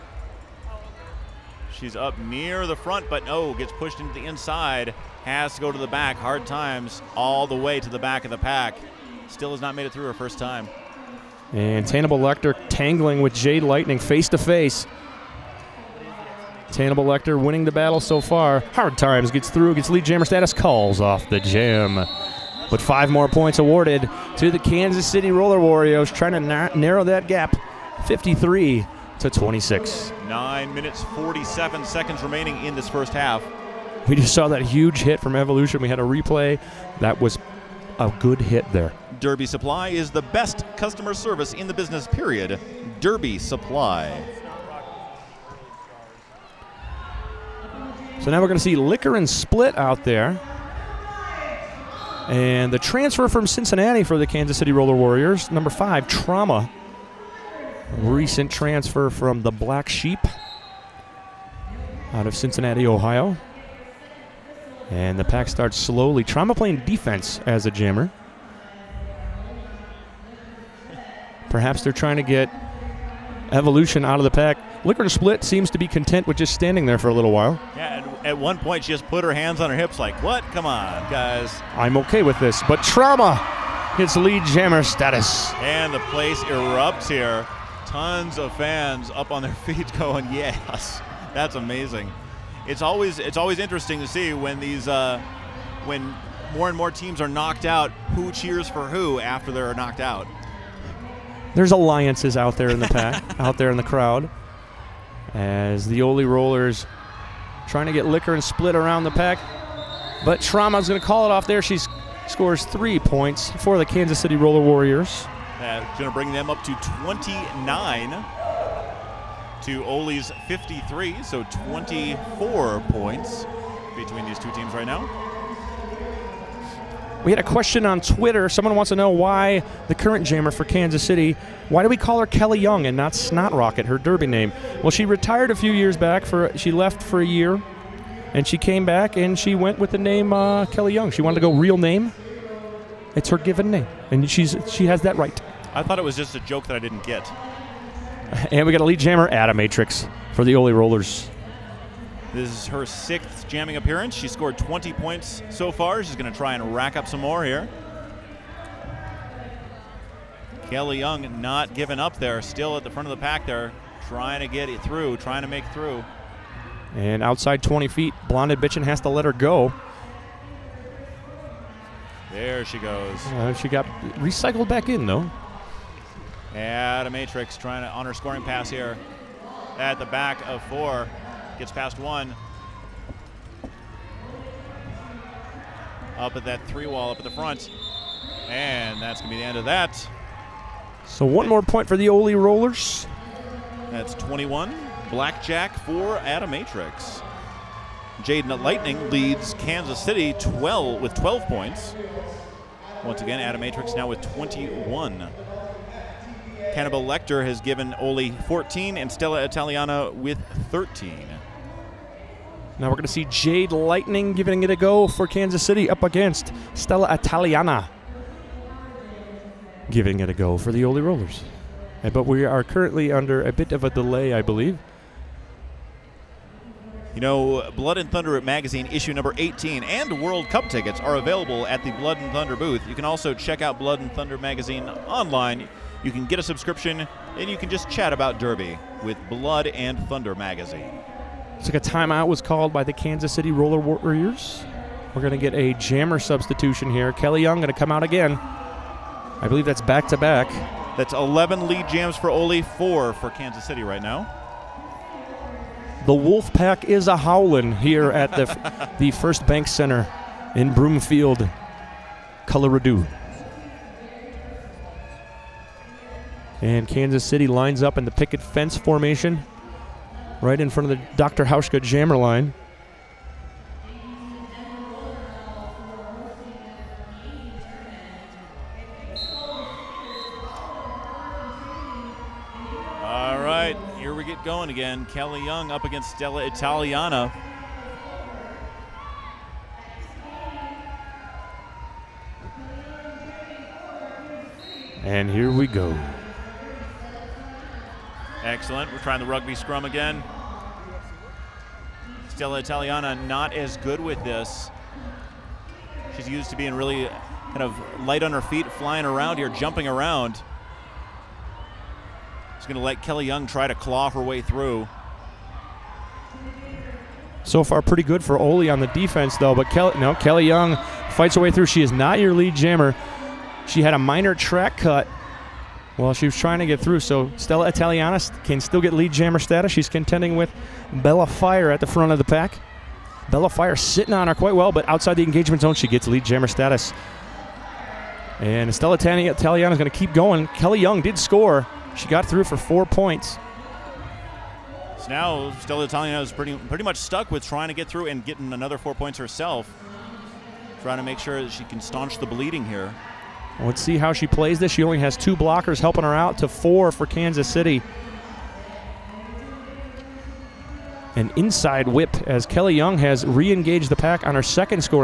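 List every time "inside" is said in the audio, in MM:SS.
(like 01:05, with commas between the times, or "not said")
00:04, 06:01.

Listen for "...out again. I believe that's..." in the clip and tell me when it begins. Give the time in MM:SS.
04:07.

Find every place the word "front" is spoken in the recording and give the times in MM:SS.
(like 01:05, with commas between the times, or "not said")
00:02, 02:42, 03:07, 04:30, 05:31.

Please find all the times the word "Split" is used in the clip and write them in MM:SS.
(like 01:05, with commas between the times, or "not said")
00:49, 01:15, 01:48.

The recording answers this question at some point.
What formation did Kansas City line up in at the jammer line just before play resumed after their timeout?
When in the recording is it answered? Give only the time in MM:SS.
04:28.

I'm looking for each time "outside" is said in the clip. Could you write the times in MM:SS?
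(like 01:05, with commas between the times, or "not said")
02:47, 05:34.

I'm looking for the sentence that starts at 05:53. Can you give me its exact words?
Let's see how she plays this.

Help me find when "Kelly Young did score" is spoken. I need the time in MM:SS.
05:40.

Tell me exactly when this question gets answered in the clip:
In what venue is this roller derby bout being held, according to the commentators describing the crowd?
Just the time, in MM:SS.
04:19.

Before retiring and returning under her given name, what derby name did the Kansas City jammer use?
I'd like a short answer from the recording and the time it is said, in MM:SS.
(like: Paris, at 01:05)
Snot Rocket, at 02:13.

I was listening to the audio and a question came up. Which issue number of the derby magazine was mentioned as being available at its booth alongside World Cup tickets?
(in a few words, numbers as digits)
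18.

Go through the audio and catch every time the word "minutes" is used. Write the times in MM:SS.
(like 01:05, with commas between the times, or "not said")
00:30.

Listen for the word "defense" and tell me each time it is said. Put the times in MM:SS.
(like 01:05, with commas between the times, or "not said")
01:06, 05:18.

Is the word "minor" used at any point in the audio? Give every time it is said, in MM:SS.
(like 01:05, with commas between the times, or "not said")
05:23.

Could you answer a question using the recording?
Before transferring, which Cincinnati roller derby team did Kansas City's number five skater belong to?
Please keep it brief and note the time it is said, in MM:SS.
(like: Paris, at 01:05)
Black Sheep, at 00:59.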